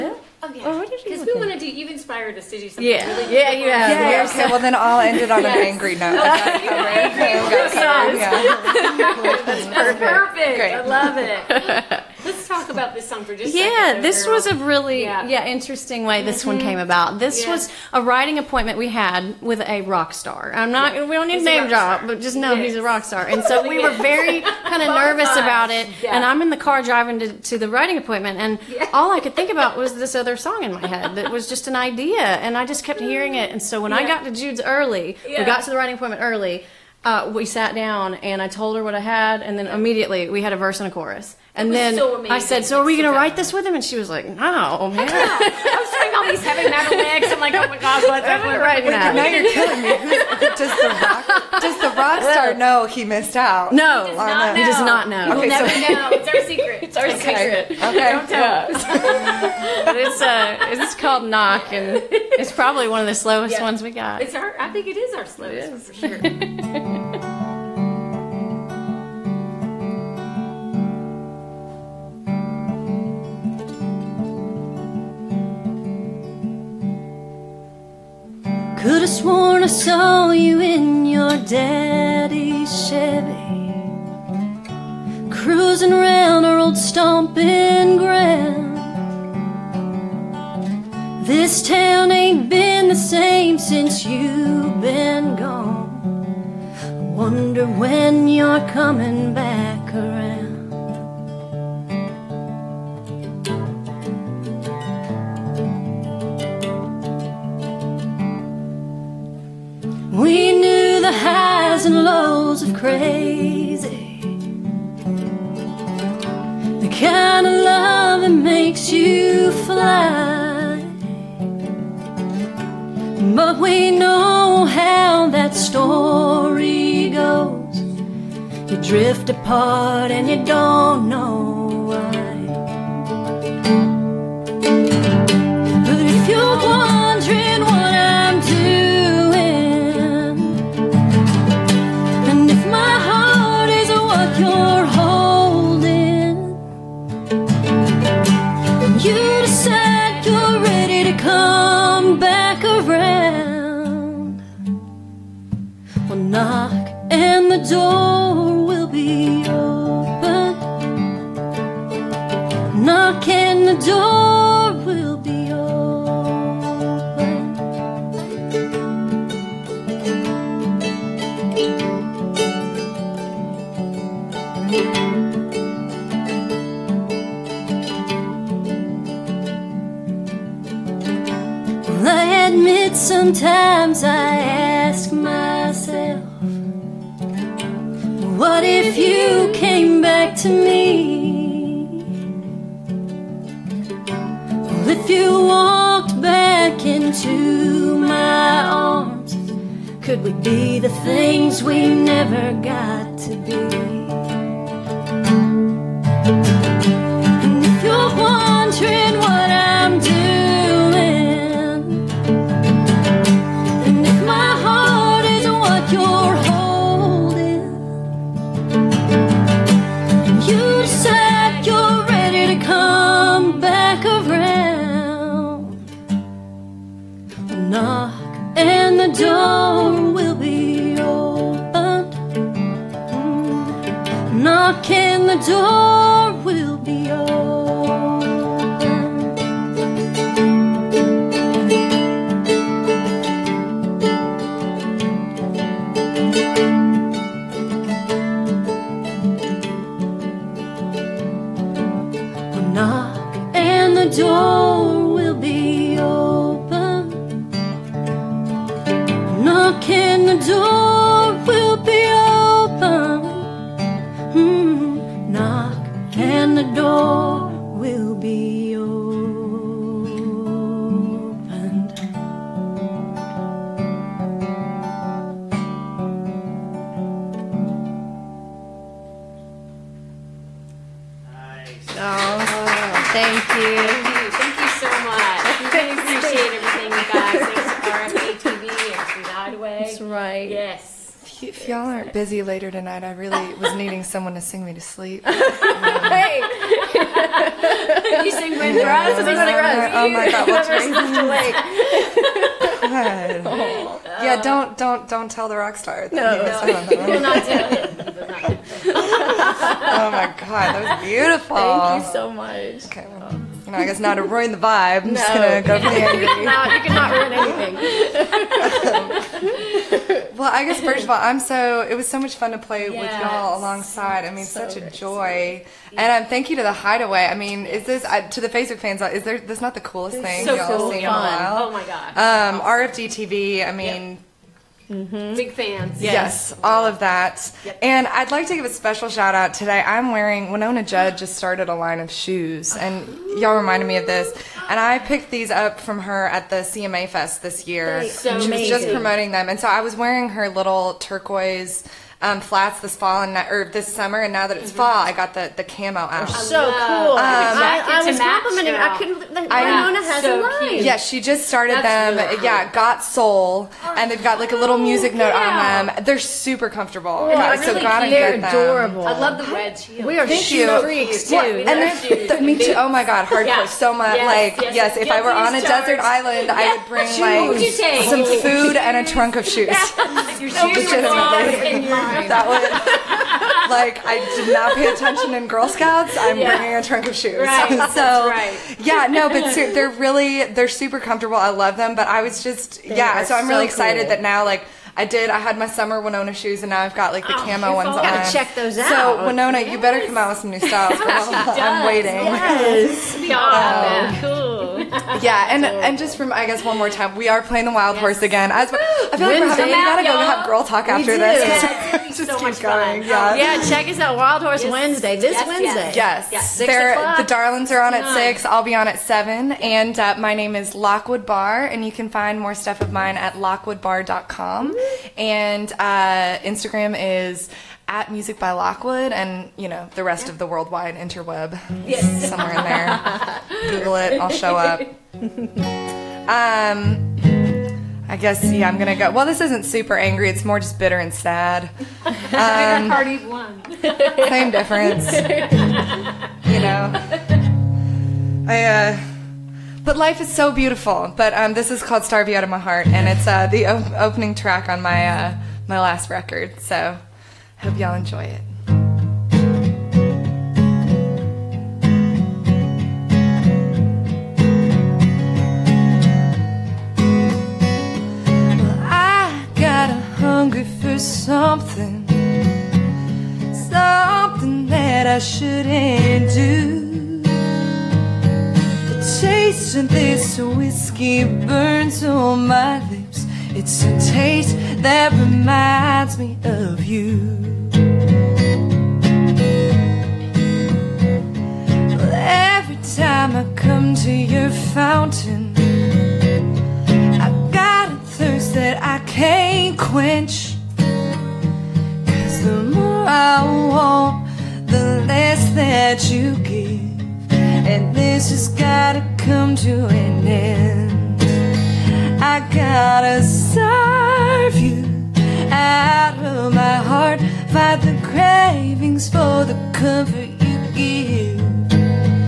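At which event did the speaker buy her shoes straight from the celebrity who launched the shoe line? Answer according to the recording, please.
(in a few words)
CMA Fest.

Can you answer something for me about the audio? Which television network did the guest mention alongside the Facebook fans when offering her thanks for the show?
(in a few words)
RFD TV.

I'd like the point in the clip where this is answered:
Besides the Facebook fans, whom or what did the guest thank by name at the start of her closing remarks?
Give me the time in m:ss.
5:26.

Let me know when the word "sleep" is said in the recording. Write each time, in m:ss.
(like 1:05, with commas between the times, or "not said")
4:54.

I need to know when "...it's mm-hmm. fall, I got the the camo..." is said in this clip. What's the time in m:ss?
5:54.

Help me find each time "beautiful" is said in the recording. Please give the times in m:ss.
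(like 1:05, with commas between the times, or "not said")
5:11, 7:30.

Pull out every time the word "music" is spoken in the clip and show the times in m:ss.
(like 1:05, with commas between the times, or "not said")
6:04, 7:08.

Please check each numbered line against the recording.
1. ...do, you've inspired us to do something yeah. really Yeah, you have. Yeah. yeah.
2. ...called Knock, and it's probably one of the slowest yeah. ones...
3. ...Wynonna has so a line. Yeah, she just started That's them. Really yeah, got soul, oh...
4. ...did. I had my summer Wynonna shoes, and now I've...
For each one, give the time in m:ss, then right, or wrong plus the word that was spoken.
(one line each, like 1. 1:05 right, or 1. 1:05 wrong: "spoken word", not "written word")
1. 0:01 right
2. 1:00 right
3. 5:59 right
4. 6:35 right.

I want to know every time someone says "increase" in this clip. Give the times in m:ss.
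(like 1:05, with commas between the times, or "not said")
not said.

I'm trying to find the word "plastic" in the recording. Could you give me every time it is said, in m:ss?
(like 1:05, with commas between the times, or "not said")
not said.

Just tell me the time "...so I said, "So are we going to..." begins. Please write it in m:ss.
0:41.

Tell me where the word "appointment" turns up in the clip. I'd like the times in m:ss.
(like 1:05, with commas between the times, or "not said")
0:18, 0:28, 0:35.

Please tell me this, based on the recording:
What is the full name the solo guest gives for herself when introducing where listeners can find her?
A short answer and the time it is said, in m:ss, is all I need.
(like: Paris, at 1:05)
Lockwood Barr, at 7:00.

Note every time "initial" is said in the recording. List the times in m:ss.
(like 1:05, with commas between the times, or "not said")
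not said.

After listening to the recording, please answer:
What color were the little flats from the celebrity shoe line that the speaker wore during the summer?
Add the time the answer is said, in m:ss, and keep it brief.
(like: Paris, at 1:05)
turquoise, at 5:50.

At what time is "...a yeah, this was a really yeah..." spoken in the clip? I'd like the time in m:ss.
0:13.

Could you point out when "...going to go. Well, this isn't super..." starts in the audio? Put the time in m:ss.
7:18.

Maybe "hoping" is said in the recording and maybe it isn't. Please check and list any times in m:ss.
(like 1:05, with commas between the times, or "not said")
not said.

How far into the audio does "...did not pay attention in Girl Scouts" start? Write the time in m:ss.
6:24.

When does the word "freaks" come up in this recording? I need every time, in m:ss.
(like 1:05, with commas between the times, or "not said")
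6:10.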